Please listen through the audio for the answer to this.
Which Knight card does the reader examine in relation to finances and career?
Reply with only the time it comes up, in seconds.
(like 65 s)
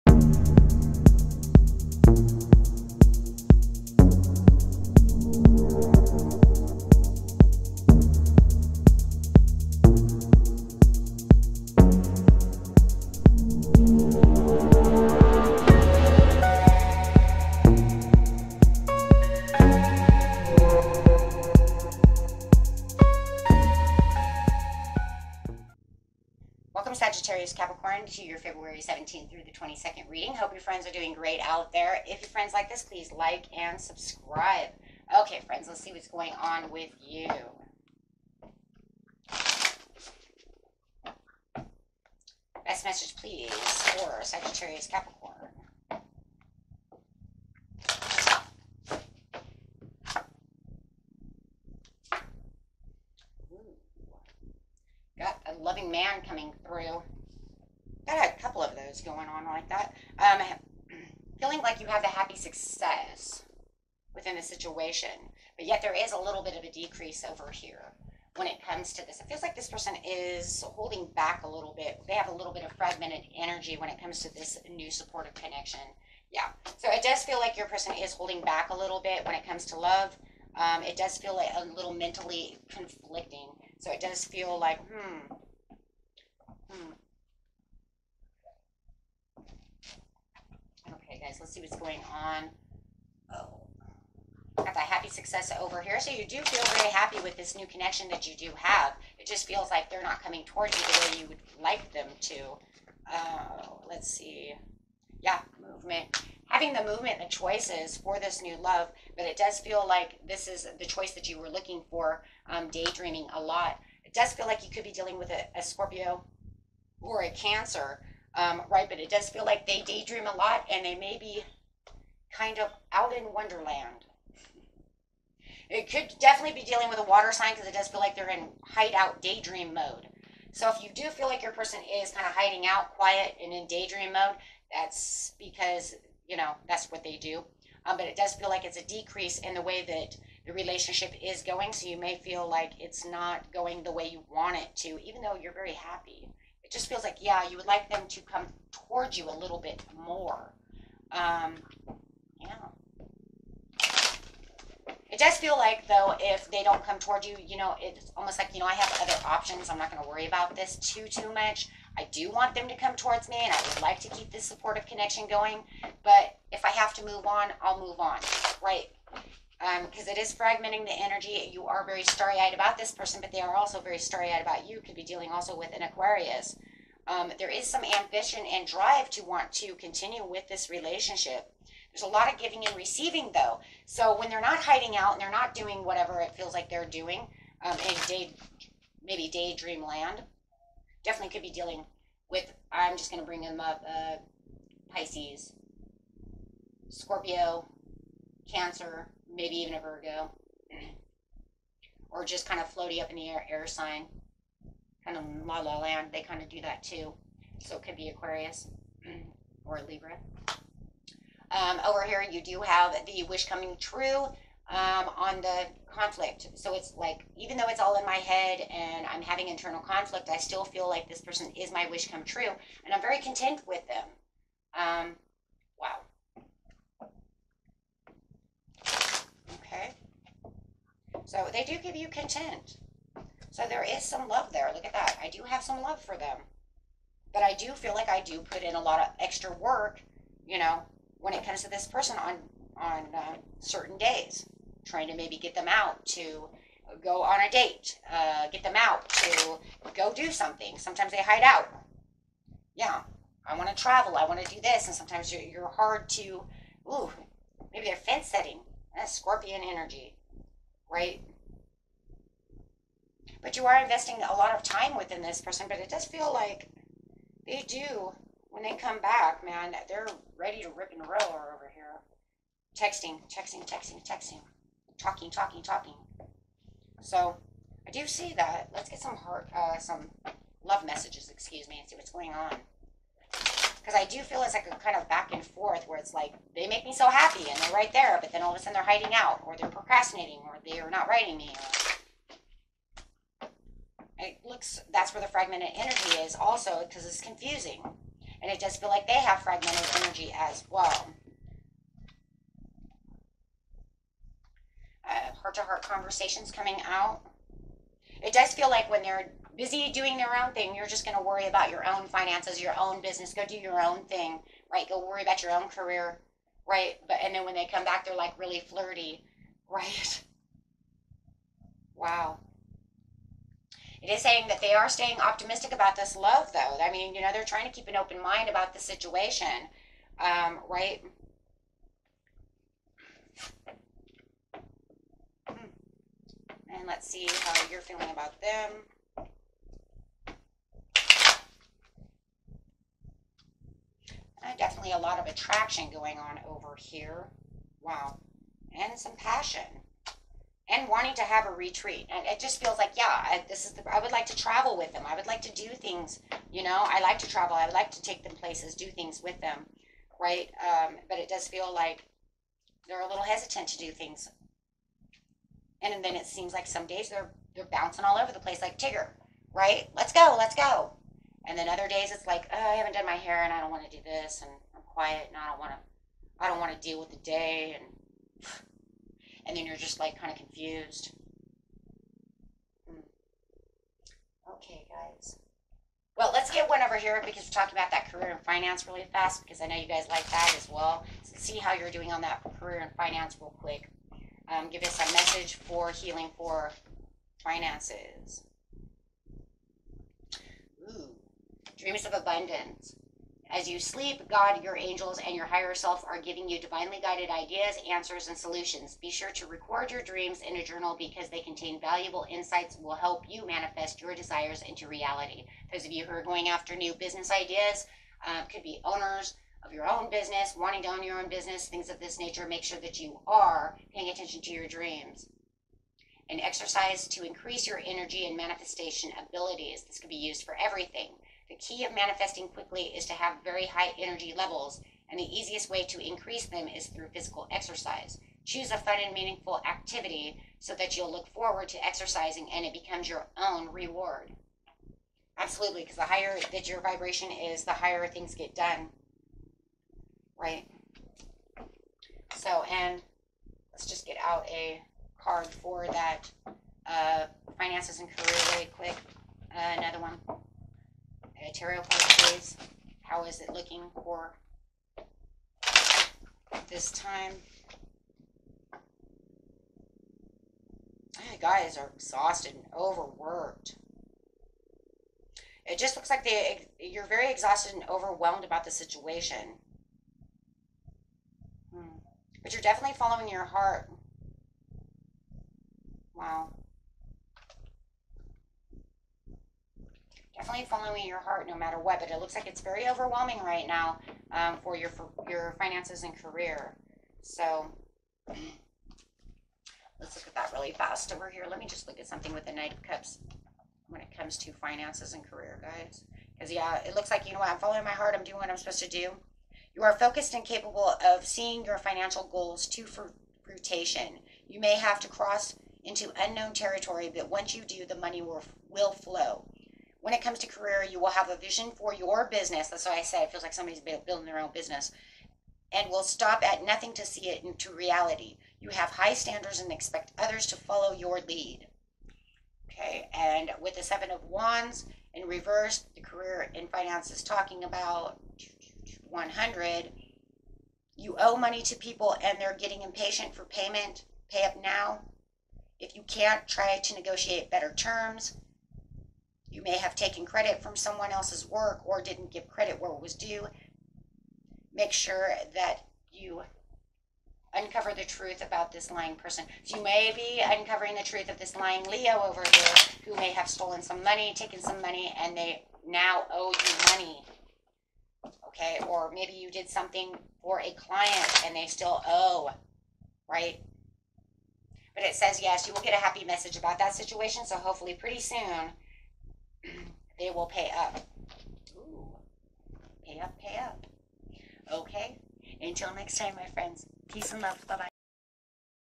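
502 s.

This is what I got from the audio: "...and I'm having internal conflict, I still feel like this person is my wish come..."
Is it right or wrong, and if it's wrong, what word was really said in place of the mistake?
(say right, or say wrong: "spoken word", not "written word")
right.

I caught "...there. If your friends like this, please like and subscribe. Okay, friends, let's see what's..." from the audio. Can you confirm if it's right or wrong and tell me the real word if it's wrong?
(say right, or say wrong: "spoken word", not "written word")
right.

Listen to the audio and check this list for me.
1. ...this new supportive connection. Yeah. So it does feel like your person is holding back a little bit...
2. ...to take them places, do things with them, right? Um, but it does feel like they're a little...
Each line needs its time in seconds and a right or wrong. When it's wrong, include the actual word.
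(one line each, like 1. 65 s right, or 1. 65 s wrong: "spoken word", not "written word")
1. 74 s right
2. 357 s right.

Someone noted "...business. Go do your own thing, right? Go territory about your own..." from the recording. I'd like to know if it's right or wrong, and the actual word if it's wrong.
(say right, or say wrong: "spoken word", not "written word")
wrong: "worry", not "territory".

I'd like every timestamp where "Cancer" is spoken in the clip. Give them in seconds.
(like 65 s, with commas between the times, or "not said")
117 s, 198 s.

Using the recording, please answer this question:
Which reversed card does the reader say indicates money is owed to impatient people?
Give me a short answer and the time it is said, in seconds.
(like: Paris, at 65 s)
Seven of Wands, at 533 s.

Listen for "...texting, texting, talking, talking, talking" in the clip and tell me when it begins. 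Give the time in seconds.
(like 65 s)
273 s.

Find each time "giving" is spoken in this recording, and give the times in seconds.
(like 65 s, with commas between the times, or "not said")
182 s, 406 s.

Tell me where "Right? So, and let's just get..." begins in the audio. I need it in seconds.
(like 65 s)
450 s.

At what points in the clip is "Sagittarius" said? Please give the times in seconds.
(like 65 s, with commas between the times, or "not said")
44 s.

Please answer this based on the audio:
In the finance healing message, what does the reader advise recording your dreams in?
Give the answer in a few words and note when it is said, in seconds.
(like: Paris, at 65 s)
a journal, at 410 s.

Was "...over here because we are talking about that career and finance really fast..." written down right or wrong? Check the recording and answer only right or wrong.
right.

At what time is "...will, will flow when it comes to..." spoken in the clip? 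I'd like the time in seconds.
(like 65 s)
518 s.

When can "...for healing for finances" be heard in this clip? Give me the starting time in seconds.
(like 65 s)
395 s.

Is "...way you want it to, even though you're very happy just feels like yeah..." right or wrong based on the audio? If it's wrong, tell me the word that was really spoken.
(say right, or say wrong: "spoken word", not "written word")
right.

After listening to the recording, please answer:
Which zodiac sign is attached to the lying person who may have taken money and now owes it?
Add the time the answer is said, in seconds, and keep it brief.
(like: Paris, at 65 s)
Leo, at 561 s.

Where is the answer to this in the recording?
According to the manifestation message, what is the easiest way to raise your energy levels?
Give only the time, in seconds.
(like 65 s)
437 s.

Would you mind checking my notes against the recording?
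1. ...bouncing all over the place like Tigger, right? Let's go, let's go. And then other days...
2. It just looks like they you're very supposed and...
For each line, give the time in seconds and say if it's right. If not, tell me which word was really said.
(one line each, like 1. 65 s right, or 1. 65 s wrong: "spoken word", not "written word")
1. 367 s right
2. 475 s wrong: "exhausted", not "supposed".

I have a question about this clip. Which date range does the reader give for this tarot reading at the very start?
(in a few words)
February 17th through the 22nd.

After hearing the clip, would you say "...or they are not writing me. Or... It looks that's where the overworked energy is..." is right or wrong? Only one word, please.
wrong.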